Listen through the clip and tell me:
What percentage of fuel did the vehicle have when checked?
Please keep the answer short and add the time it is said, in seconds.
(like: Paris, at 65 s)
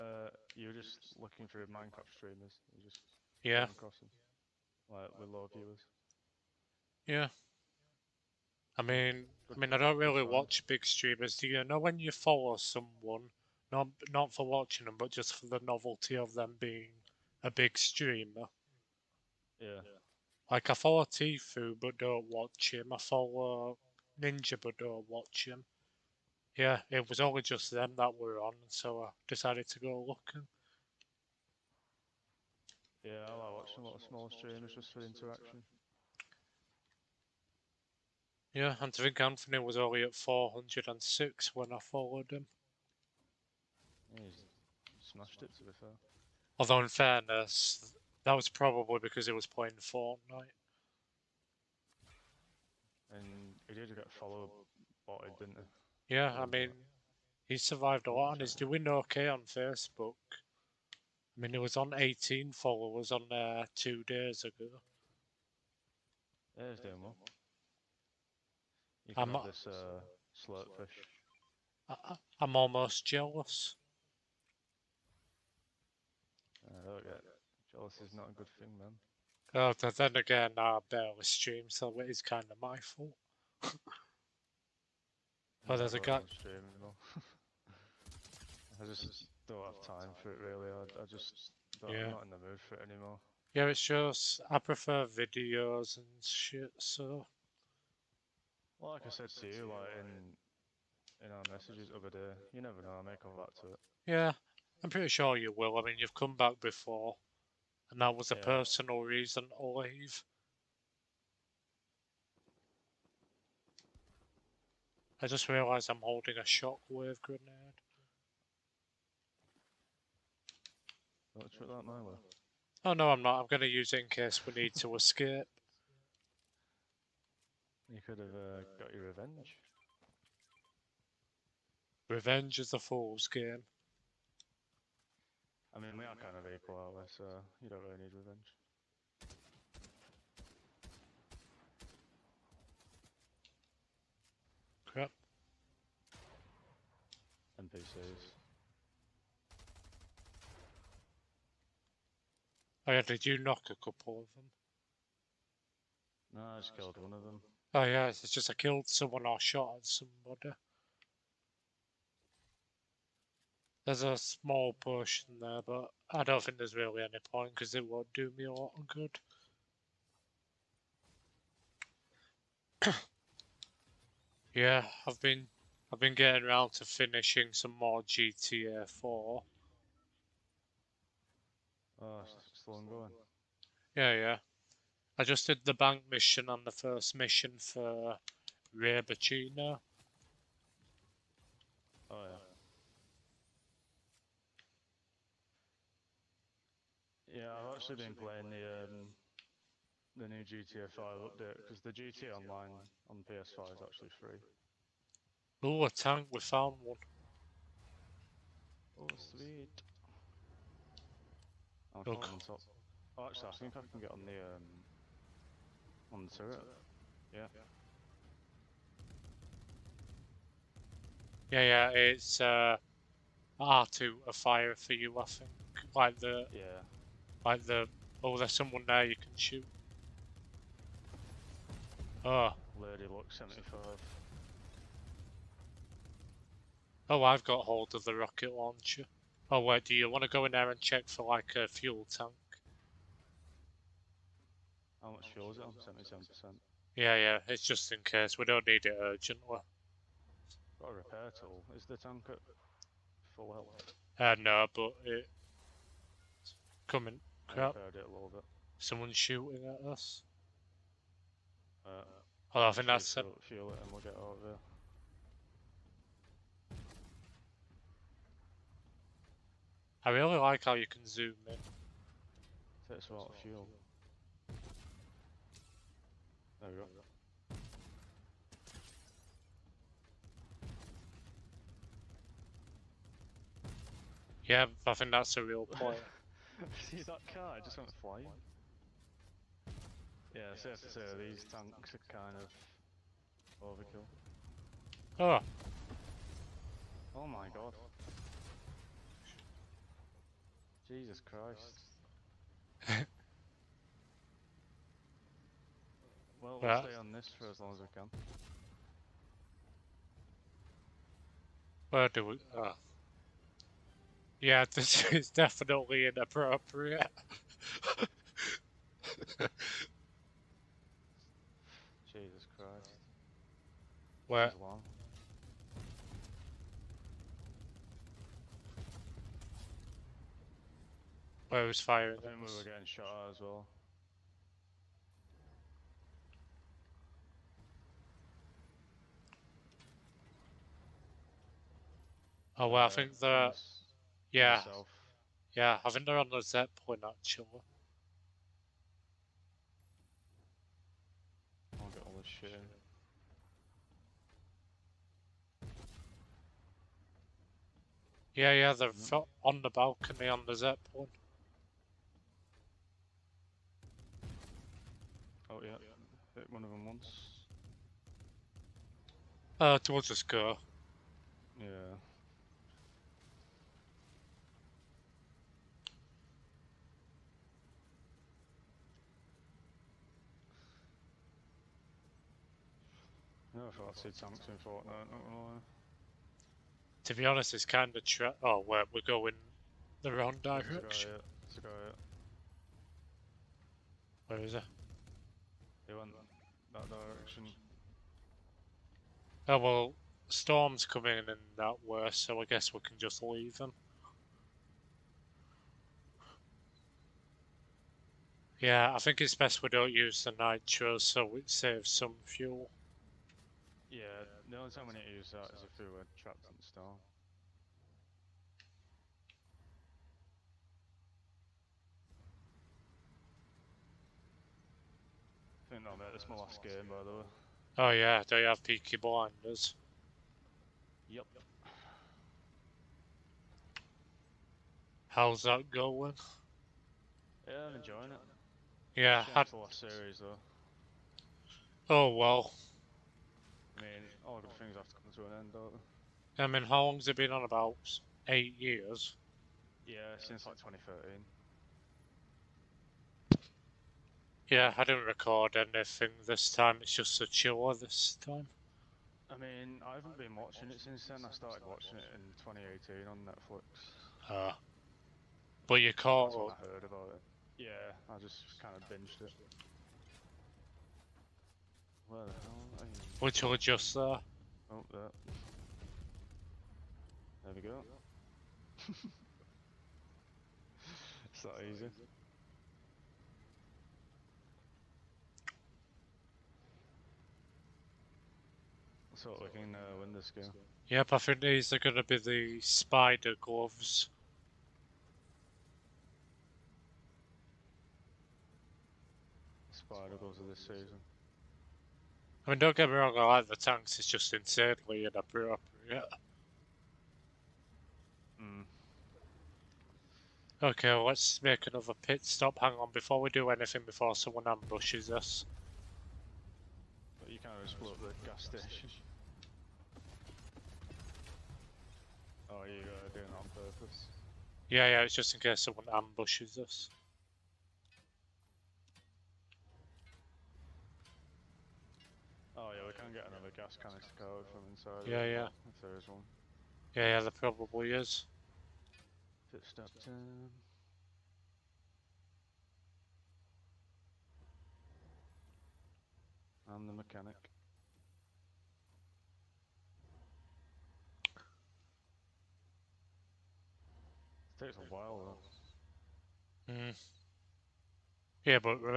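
77%, at 245 s.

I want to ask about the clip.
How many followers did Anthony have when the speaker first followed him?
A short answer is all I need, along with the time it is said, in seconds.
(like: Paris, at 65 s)
406, at 40 s.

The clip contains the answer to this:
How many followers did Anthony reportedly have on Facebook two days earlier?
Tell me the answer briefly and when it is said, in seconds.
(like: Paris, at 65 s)
18, at 61 s.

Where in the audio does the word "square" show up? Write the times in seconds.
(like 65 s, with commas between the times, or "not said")
not said.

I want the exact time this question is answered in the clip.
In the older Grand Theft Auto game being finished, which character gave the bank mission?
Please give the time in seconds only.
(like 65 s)
188 s.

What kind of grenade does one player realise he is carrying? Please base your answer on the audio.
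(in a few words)
Shockwave grenade.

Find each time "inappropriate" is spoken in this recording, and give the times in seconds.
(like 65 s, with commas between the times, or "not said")
316 s, 505 s.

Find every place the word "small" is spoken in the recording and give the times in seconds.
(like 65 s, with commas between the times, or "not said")
34 s, 164 s.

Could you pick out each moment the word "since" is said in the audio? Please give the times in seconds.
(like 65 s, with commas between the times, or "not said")
450 s, 460 s.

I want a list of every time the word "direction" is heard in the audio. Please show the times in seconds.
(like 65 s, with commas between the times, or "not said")
390 s, 396 s.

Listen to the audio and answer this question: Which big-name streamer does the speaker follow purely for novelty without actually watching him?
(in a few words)
Tfue.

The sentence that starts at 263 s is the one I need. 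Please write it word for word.
Fuel, fuel it and we'll get out of here.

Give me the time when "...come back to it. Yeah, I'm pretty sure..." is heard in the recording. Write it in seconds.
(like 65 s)
103 s.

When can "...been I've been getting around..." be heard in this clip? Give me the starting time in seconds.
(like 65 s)
175 s.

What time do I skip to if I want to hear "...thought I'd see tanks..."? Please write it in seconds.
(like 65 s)
383 s.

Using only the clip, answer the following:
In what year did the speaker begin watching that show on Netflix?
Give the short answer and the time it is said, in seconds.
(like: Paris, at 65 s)
2018, at 462 s.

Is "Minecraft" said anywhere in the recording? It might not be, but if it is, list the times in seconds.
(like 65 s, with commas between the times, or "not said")
1 s.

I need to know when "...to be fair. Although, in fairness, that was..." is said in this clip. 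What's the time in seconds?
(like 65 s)
45 s.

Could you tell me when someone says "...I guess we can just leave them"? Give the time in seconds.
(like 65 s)
402 s.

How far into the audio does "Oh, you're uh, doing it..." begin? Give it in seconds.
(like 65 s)
522 s.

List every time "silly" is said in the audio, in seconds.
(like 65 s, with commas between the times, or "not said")
not said.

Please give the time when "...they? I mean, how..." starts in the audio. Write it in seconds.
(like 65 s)
446 s.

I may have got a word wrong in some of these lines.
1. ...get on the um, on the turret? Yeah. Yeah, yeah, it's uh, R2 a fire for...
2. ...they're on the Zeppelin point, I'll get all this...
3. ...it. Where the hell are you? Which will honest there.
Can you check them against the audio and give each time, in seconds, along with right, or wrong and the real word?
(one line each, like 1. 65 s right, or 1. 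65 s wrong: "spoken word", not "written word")
1. 213 s right
2. 346 s right
3. 469 s wrong: "adjust", not "honest".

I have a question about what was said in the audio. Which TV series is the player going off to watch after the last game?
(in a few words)
Peaky Blinders.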